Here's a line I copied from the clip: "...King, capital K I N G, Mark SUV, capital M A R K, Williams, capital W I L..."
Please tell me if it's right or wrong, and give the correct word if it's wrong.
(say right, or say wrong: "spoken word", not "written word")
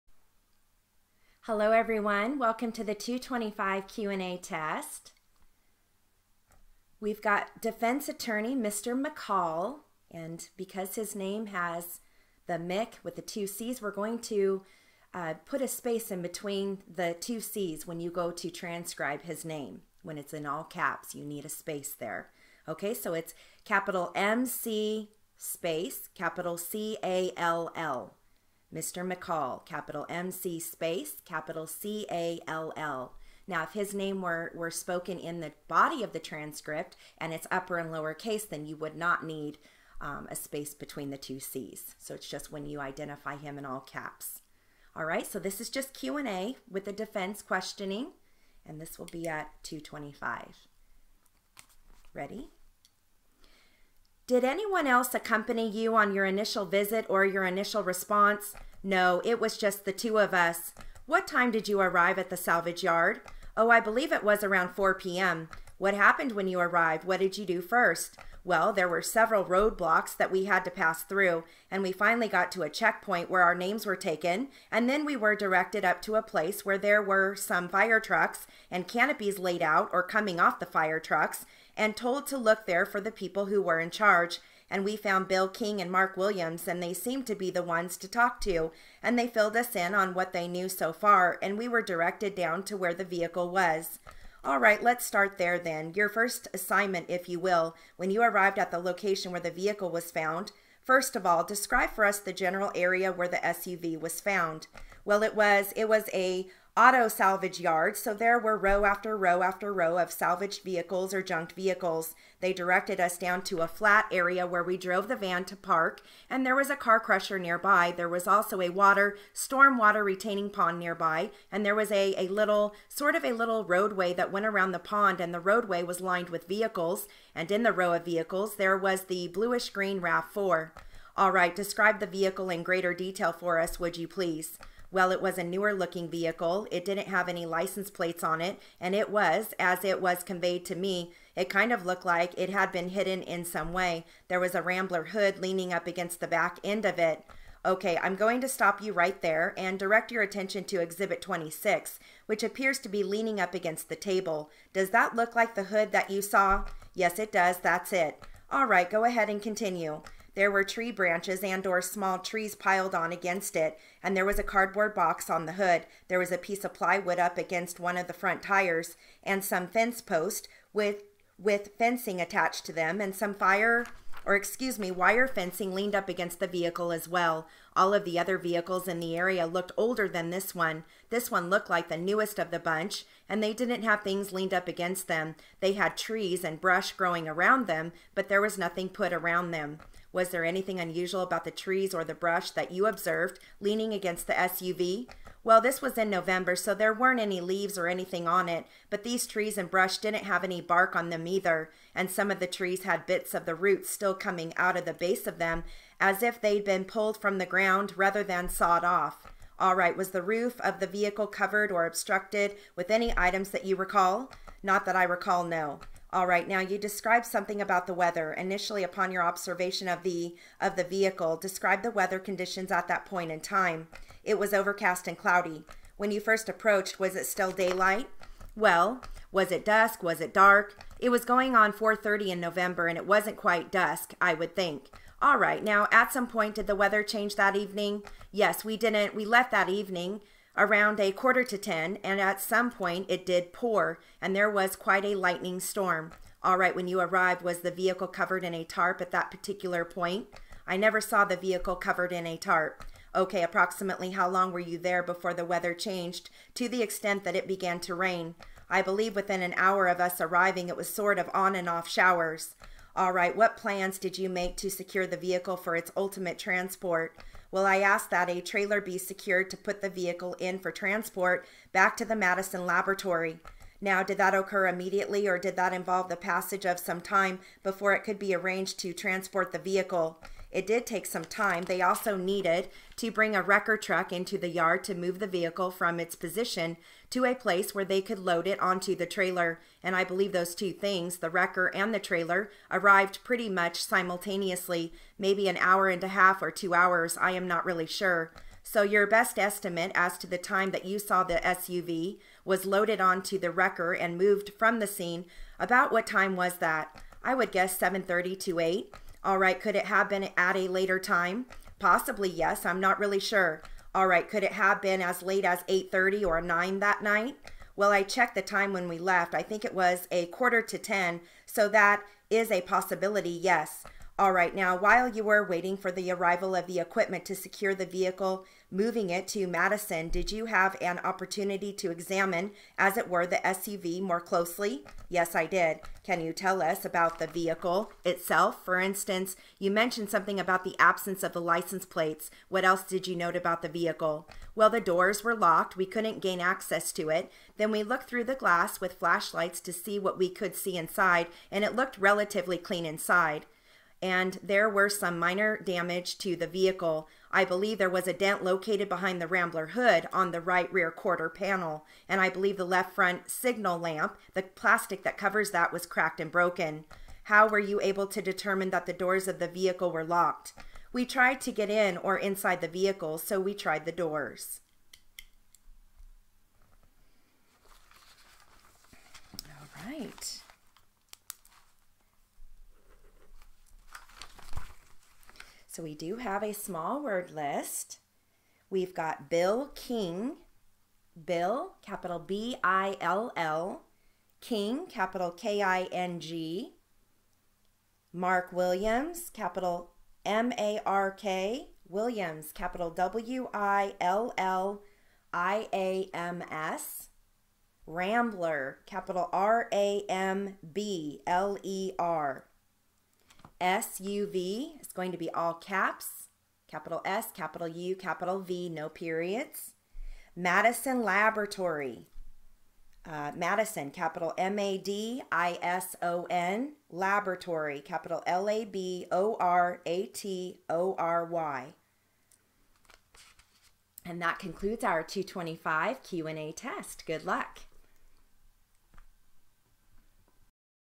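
wrong: "Williams", not "SUV".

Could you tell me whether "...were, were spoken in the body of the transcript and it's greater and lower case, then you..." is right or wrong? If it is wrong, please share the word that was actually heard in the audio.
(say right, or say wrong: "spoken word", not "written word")
wrong: "upper", not "greater".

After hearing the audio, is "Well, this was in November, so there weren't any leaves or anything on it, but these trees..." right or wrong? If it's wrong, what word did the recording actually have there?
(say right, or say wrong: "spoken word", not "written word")
right.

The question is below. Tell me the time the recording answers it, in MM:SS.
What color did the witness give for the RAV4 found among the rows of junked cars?
02:09.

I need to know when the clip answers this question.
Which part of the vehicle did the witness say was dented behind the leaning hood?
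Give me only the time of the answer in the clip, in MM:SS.
06:00.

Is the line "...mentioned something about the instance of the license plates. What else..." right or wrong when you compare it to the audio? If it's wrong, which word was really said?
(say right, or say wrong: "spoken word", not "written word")
wrong: "absence", not "instance".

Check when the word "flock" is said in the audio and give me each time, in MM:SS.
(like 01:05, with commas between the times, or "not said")
not said.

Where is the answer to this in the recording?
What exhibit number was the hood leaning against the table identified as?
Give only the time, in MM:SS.
02:30.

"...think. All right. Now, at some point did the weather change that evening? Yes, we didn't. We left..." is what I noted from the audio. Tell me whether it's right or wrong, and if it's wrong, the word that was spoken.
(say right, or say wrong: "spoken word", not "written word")
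right.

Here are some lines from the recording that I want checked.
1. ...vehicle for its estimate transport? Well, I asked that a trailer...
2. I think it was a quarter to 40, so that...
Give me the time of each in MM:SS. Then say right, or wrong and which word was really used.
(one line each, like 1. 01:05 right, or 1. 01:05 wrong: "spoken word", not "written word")
1. 04:25 wrong: "ultimate", not "estimate"
2. 05:19 wrong: "10", not "40".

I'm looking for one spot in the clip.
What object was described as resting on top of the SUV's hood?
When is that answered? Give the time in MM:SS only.
02:44.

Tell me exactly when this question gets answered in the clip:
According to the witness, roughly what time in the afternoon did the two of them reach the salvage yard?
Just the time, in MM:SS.
01:04.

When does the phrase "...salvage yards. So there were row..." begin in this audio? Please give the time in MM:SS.
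01:47.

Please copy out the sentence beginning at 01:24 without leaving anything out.
And we found Bill King and Mark Williams, and they seemed to be the ones to talk to.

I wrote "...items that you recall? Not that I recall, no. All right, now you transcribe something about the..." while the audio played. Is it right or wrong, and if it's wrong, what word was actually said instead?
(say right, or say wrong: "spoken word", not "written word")
wrong: "describe", not "transcribe".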